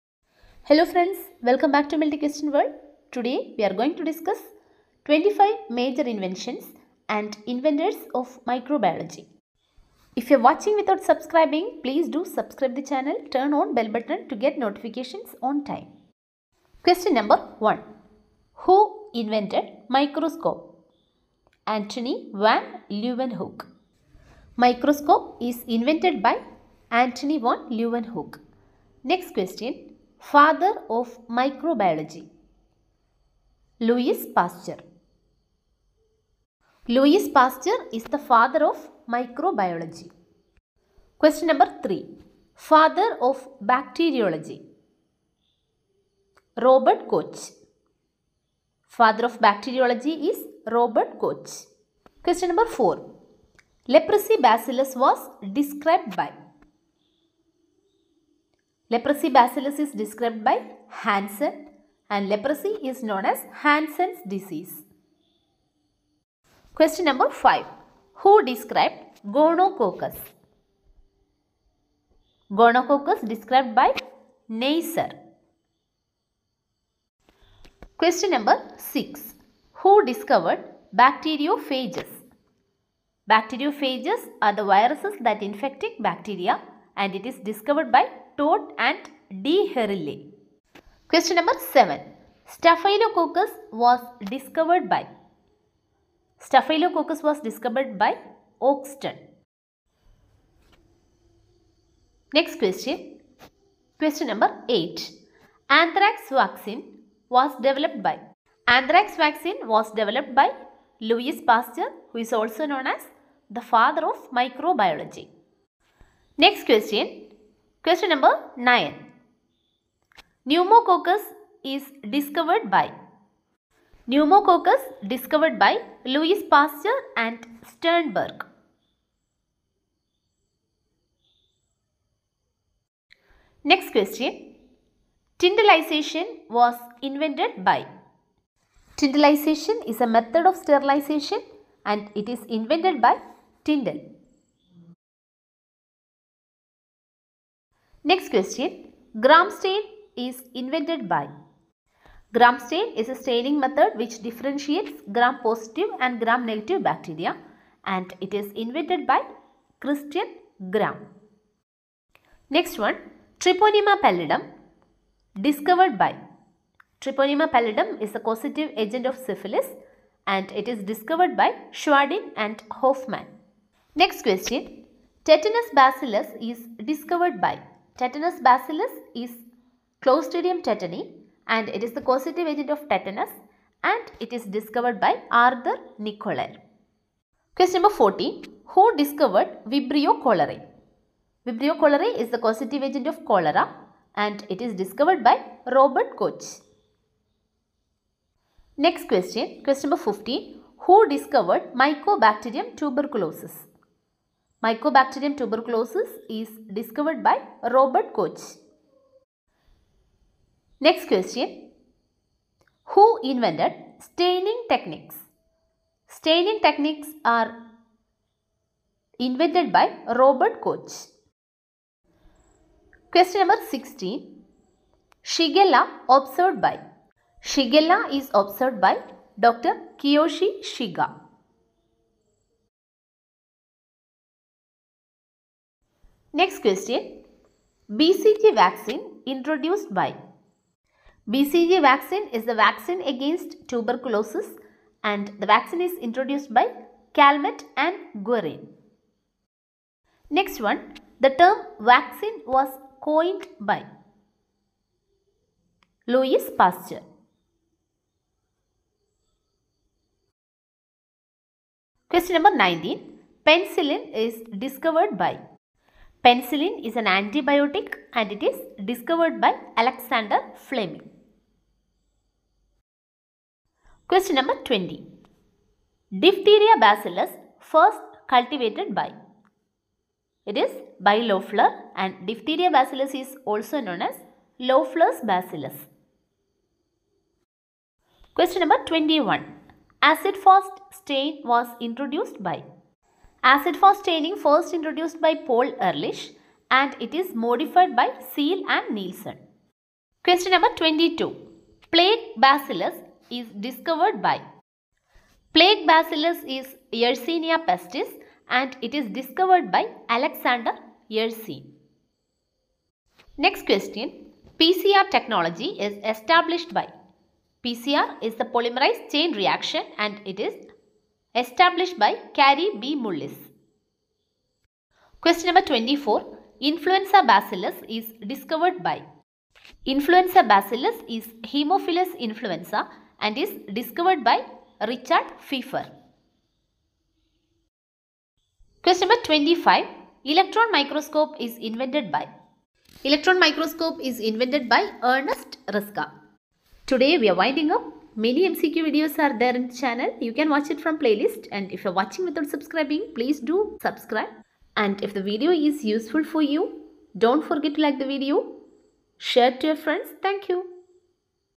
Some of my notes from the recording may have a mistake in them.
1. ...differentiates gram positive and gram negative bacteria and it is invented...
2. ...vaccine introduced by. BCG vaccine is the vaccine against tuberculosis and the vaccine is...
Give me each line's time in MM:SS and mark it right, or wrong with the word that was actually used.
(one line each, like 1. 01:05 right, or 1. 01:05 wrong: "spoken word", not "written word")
1. 02:34 right
2. 03:58 right.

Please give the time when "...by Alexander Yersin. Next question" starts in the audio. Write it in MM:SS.
05:09.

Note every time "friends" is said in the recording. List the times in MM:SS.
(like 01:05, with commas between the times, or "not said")
00:00, 05:59.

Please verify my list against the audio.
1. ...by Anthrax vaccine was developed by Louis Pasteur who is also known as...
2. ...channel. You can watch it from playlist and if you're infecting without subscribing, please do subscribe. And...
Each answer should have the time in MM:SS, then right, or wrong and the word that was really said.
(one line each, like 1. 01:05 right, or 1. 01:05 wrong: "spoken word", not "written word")
1. 01:48 right
2. 05:49 wrong: "watching", not "infecting".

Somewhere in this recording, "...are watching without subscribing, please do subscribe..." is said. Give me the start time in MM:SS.
00:10.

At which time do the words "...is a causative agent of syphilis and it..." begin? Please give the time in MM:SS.
02:48.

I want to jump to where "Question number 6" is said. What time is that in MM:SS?
01:17.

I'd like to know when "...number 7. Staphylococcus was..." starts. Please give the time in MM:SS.
01:31.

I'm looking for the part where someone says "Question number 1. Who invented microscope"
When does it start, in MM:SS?
00:16.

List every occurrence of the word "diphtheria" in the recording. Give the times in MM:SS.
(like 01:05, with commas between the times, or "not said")
04:36, 04:42.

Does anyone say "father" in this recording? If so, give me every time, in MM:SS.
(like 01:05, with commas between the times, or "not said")
00:30, 00:38, 00:42, 00:48, 01:53.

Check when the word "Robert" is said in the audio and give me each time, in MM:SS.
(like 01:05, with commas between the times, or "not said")
00:46, 00:50, 03:15, 03:27, 03:40.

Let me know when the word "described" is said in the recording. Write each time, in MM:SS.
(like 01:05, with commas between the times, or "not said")
00:55, 00:59, 01:08, 01:13.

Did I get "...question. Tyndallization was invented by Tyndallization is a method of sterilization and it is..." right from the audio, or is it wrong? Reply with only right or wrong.
right.